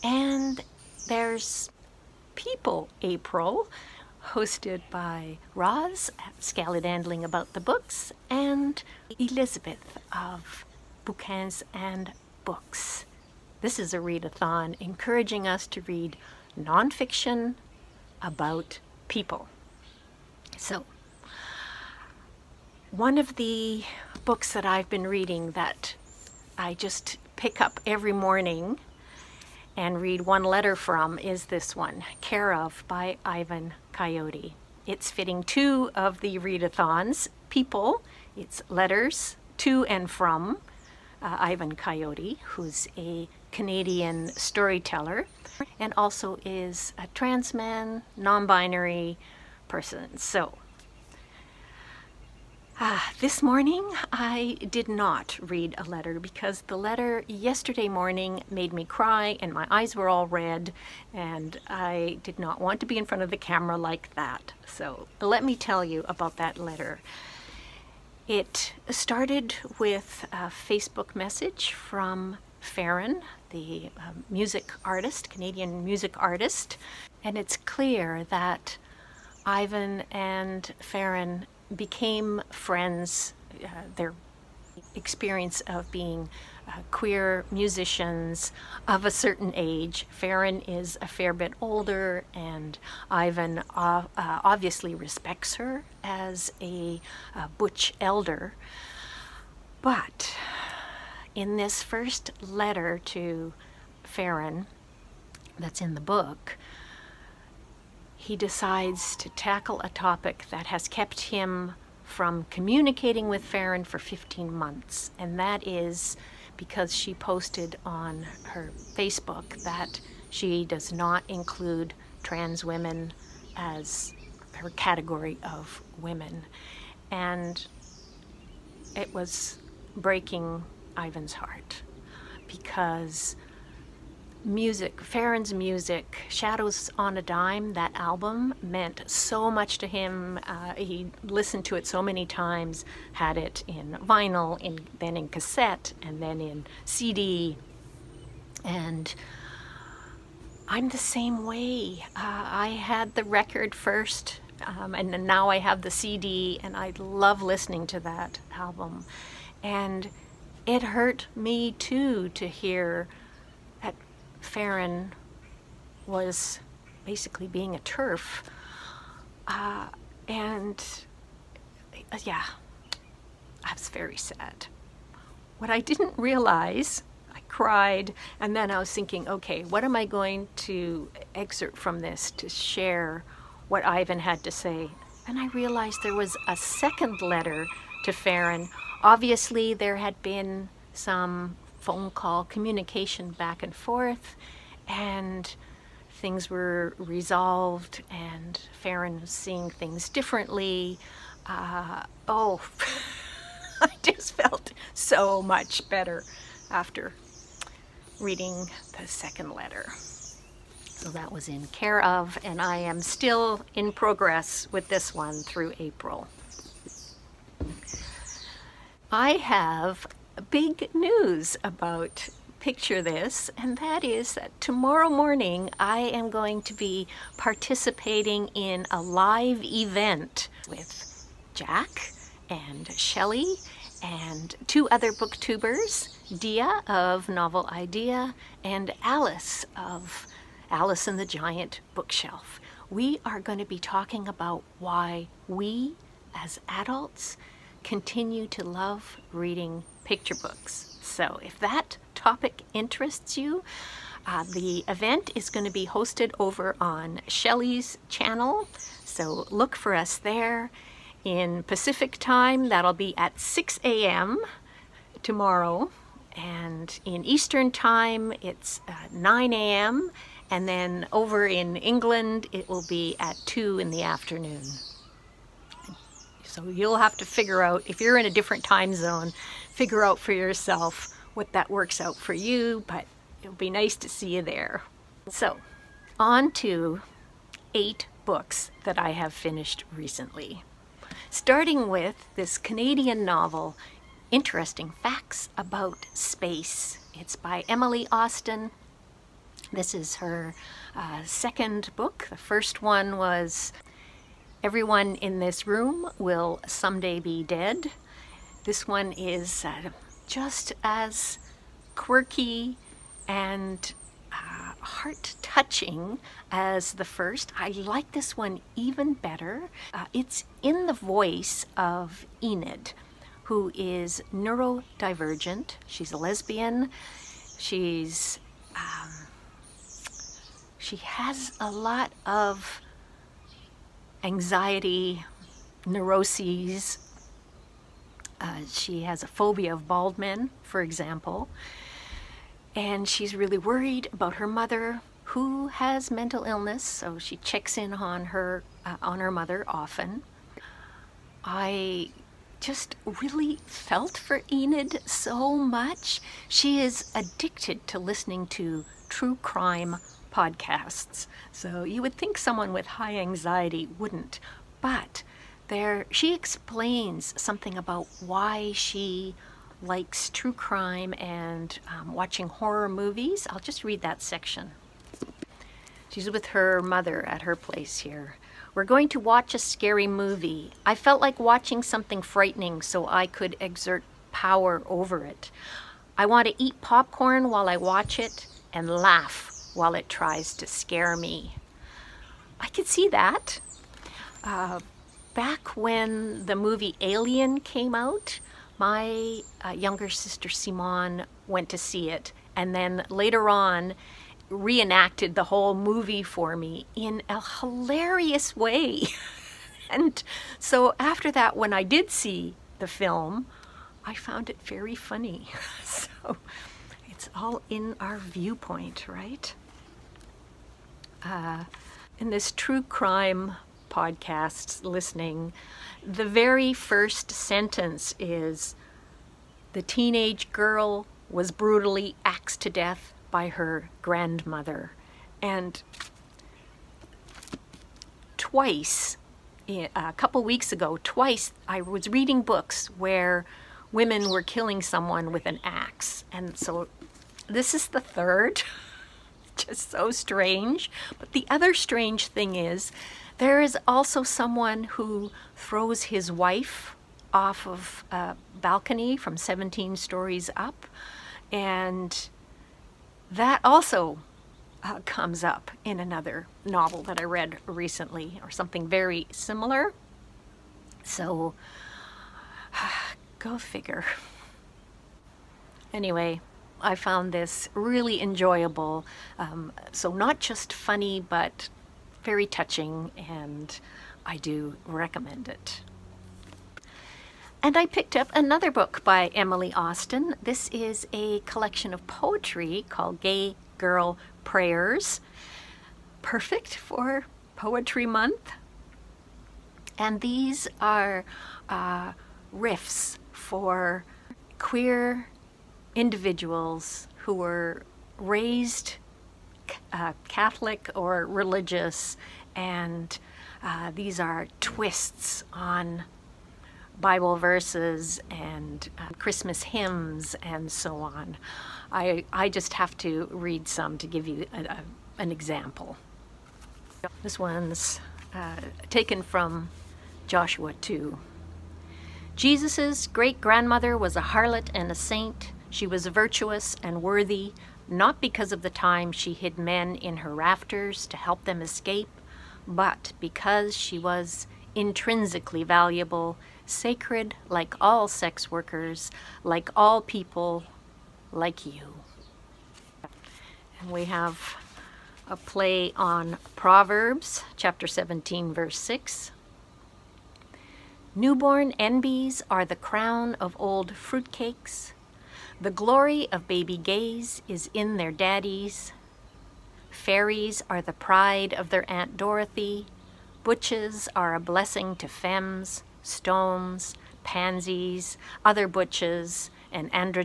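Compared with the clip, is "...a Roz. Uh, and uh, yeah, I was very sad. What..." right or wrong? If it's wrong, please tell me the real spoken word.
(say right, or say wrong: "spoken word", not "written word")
wrong: "TERF", not "Roz".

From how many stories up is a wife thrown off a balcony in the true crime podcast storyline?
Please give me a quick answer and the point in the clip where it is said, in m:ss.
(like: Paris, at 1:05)
17, at 7:39.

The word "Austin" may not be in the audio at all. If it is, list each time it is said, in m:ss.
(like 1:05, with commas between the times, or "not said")
4:58, 8:09.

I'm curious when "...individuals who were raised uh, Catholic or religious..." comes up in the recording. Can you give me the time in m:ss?
8:25.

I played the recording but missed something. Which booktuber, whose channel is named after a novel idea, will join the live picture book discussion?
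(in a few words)
Dia.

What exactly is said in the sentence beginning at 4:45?
So on to eight books that I have finished recently.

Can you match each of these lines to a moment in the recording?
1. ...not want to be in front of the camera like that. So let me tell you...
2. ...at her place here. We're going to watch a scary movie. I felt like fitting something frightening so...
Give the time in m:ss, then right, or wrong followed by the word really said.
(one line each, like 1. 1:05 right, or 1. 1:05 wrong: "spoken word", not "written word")
1. 1:02 right
2. 6:17 wrong: "watching", not "fitting".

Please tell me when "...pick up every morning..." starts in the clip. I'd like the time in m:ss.
0:27.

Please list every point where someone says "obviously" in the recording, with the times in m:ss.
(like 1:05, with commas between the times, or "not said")
1:34, 3:09.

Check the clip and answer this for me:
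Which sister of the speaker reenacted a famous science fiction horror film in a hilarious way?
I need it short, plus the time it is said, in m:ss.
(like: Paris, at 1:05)
Simone, at 6:40.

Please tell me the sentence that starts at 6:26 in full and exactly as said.
I want to eat popcorn while I watch it and laugh while it tries to scare me.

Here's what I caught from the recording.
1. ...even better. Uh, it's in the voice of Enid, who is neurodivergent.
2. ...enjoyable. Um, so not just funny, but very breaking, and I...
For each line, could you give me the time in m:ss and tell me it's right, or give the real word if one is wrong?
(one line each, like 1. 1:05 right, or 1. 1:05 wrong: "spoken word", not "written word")
1. 5:18 right
2. 7:58 wrong: "touching", not "breaking".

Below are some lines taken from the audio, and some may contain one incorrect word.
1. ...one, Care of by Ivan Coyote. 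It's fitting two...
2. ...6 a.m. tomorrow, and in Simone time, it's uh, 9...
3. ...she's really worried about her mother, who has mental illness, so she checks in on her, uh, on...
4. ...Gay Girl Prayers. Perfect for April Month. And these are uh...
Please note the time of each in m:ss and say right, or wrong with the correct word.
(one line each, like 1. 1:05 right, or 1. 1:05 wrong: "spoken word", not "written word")
1. 0:31 right
2. 4:23 wrong: "Eastern", not "Simone"
3. 5:43 right
4. 8:13 wrong: "Poetry", not "April".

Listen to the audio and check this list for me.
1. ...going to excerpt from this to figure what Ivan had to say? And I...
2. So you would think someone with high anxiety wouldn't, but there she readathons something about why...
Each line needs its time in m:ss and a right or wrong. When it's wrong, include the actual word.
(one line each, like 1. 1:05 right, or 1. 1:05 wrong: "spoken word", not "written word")
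1. 3:00 wrong: "share", not "figure"
2. 6:01 wrong: "explains", not "readathons".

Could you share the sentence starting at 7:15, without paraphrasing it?
And twice, a couple weeks ago, twice I was reading books where women were killing someone with an axe.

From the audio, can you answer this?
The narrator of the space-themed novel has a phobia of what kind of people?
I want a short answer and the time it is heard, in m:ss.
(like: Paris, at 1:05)
Bald men, at 5:39.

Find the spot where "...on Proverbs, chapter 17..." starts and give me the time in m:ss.
9:15.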